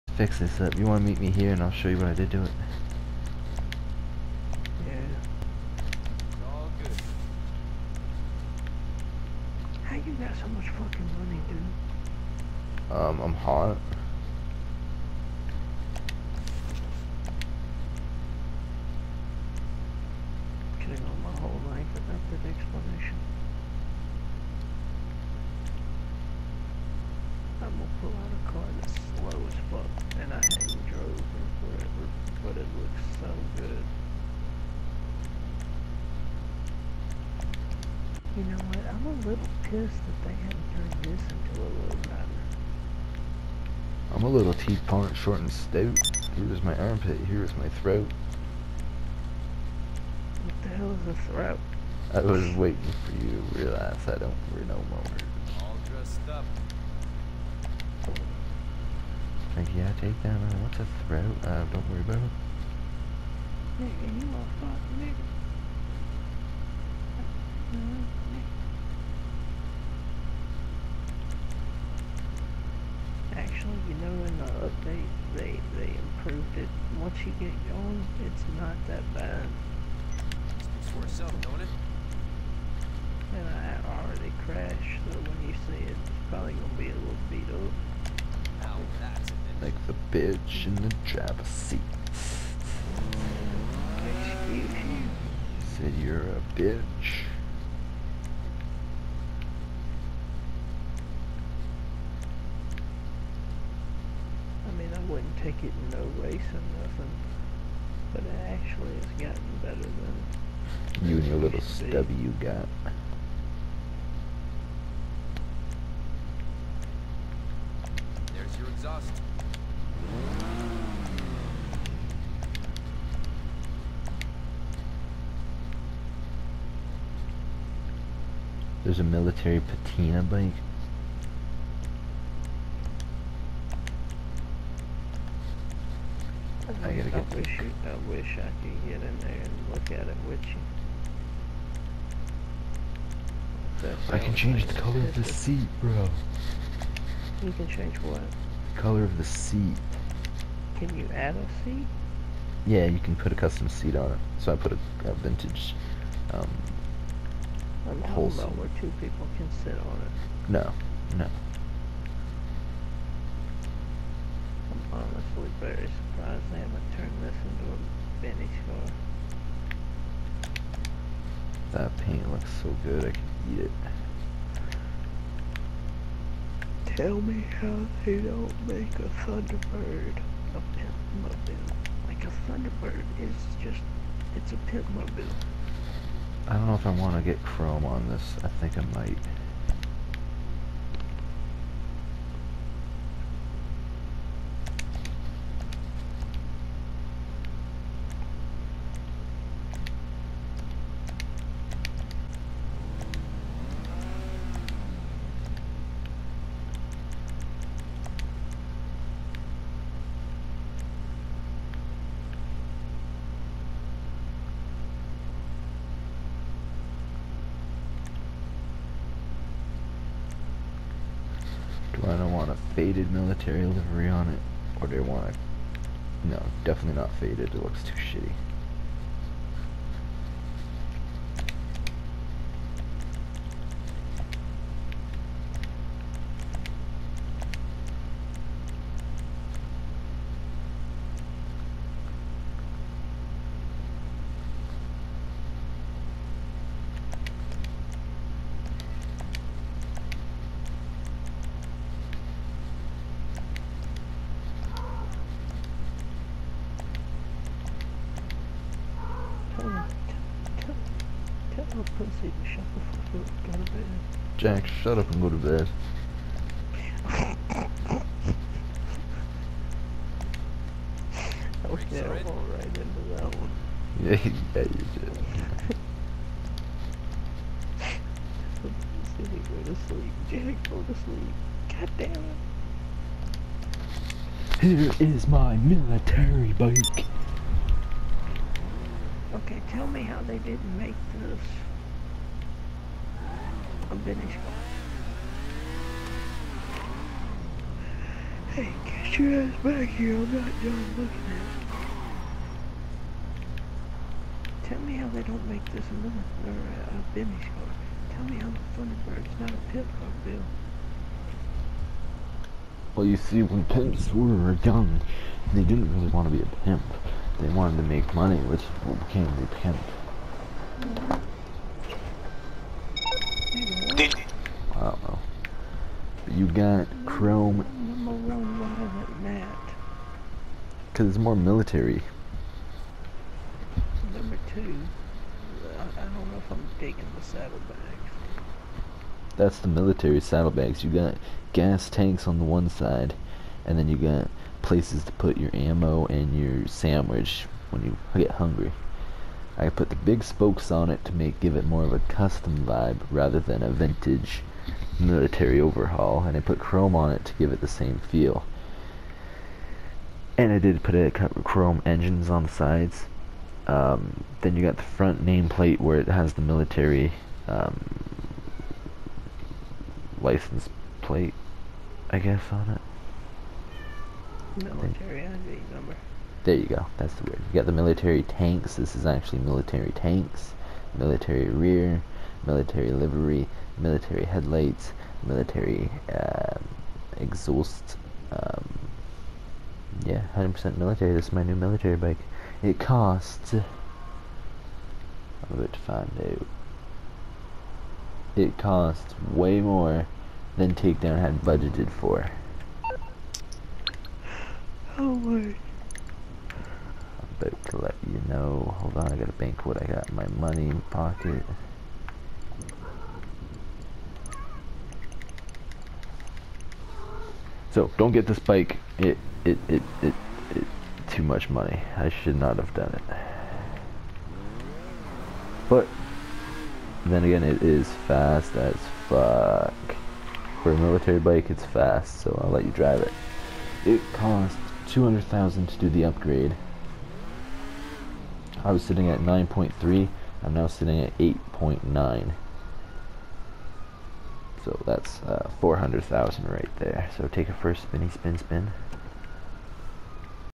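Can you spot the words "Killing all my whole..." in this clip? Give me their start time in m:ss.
0:20.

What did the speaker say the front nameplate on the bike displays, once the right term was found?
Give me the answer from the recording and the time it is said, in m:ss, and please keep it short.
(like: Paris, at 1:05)
Military ID number, at 6:14.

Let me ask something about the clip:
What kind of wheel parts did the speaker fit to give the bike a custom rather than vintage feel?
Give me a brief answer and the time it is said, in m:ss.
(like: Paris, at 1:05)
Big spokes, at 5:49.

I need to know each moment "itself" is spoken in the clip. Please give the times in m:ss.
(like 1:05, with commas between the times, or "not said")
1:21.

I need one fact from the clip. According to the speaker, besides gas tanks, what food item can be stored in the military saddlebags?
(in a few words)
Sandwich.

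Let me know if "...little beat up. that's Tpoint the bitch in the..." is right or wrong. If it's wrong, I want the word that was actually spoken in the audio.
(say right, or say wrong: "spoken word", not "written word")
wrong: "Like", not "Tpoint".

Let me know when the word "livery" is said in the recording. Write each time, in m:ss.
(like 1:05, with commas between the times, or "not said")
3:43, 6:22.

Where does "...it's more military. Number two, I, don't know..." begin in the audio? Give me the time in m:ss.
5:31.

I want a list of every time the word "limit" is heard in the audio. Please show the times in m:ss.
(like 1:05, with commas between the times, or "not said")
5:05.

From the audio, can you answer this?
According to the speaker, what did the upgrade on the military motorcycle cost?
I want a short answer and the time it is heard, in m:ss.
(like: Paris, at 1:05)
200,000, at 7:14.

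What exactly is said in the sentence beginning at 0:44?
I'm a little T-point short and stout.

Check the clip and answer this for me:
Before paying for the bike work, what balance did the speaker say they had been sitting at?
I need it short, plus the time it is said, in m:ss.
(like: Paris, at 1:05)
9.3, at 7:19.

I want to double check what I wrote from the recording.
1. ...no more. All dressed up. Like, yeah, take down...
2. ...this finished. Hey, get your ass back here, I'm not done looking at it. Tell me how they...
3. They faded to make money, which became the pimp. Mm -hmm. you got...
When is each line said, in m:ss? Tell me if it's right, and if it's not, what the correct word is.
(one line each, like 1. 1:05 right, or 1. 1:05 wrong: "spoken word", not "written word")
1. 0:54 right
2. 4:51 right
3. 5:17 wrong: "wanted", not "faded".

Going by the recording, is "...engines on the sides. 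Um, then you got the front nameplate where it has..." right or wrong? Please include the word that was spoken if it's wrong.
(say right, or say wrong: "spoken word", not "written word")
right.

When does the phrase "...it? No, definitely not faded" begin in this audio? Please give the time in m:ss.
3:45.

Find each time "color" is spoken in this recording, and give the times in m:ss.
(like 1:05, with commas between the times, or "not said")
2:24, 2:28.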